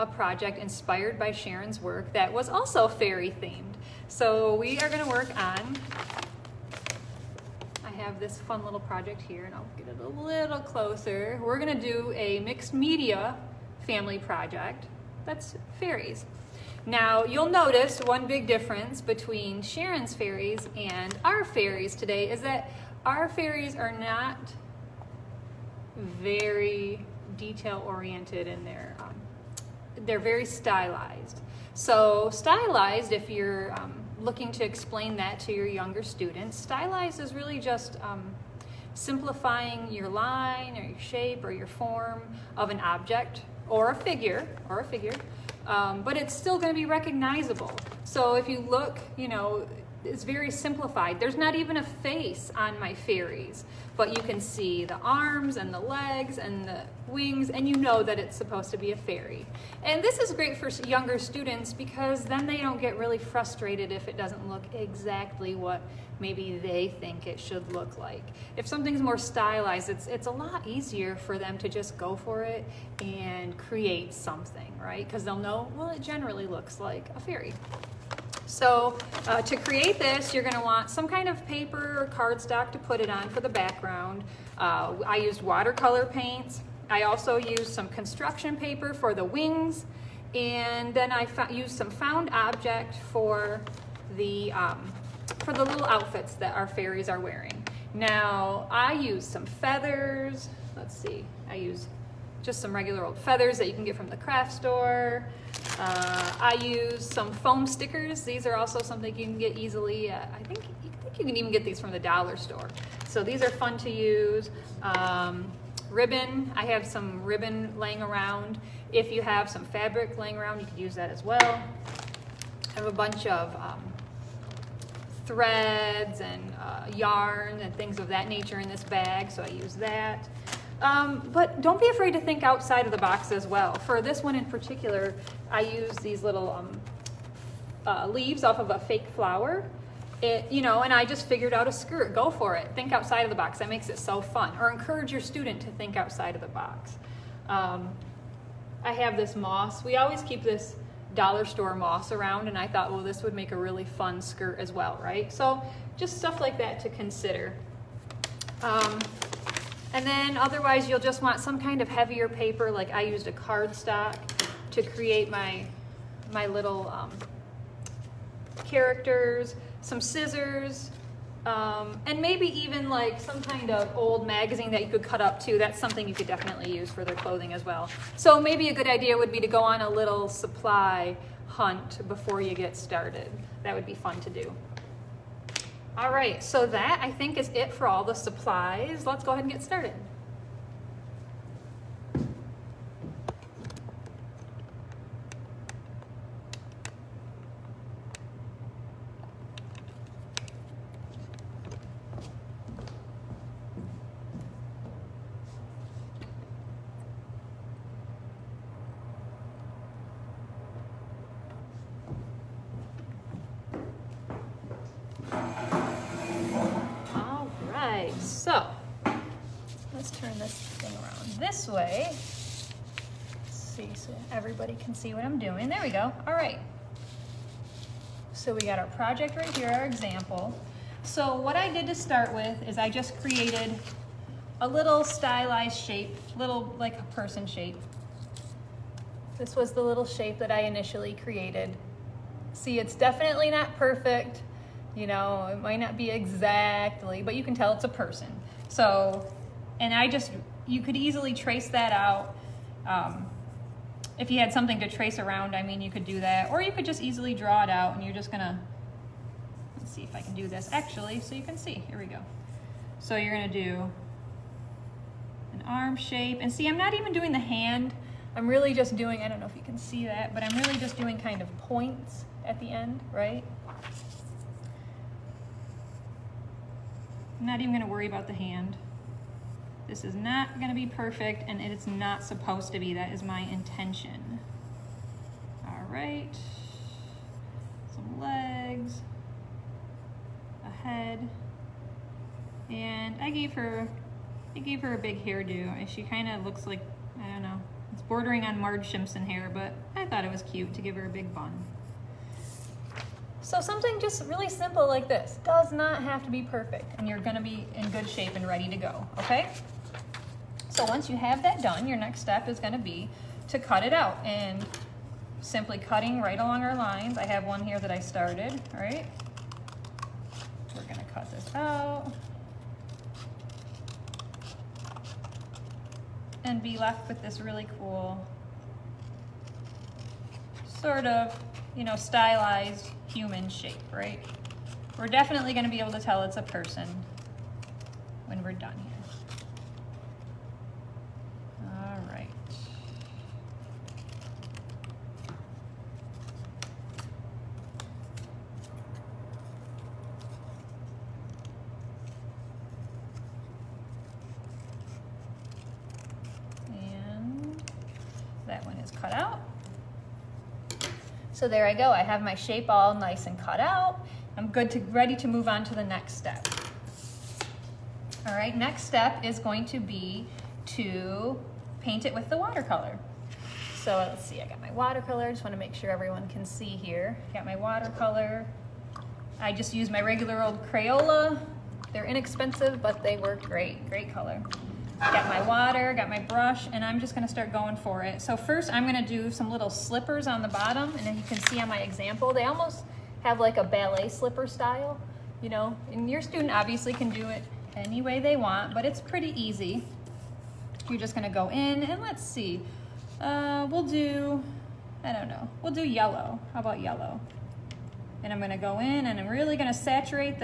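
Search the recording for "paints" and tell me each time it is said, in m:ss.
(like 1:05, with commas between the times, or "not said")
1:26, 6:11.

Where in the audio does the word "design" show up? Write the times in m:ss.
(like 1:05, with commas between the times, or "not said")
not said.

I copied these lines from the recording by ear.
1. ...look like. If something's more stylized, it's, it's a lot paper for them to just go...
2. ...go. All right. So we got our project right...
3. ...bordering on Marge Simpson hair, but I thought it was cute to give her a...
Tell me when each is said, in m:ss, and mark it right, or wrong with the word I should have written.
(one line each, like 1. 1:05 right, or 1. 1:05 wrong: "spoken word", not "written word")
1. 1:07 wrong: "easier", not "paper"
2. 3:45 right
3. 4:58 right.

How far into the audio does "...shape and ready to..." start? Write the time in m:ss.
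5:08.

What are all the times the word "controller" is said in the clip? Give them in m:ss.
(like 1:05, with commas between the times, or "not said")
not said.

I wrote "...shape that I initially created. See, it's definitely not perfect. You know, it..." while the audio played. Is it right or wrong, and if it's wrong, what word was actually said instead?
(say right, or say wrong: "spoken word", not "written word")
right.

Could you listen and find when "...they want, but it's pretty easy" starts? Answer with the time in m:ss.
6:38.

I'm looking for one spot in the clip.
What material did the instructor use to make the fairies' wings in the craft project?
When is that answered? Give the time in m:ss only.
1:27.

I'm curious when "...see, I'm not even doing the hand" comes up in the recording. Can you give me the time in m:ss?
4:26.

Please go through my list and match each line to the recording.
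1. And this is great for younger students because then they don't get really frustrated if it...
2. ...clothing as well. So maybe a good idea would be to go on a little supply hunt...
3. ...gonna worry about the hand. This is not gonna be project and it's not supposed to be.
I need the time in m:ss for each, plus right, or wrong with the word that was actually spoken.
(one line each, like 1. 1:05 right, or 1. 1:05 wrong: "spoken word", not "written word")
1. 0:59 right
2. 2:57 right
3. 4:37 wrong: "perfect", not "project".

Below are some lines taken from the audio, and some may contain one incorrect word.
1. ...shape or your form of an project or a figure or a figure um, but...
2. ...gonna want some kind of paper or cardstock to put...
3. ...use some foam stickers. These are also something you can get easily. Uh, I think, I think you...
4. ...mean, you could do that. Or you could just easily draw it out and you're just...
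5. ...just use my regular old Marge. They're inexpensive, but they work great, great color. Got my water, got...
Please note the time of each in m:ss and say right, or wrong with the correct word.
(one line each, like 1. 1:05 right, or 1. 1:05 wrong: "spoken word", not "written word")
1. 0:40 wrong: "object", not "project"
2. 1:20 right
3. 1:46 right
4. 4:15 right
5. 6:19 wrong: "Crayola", not "Marge".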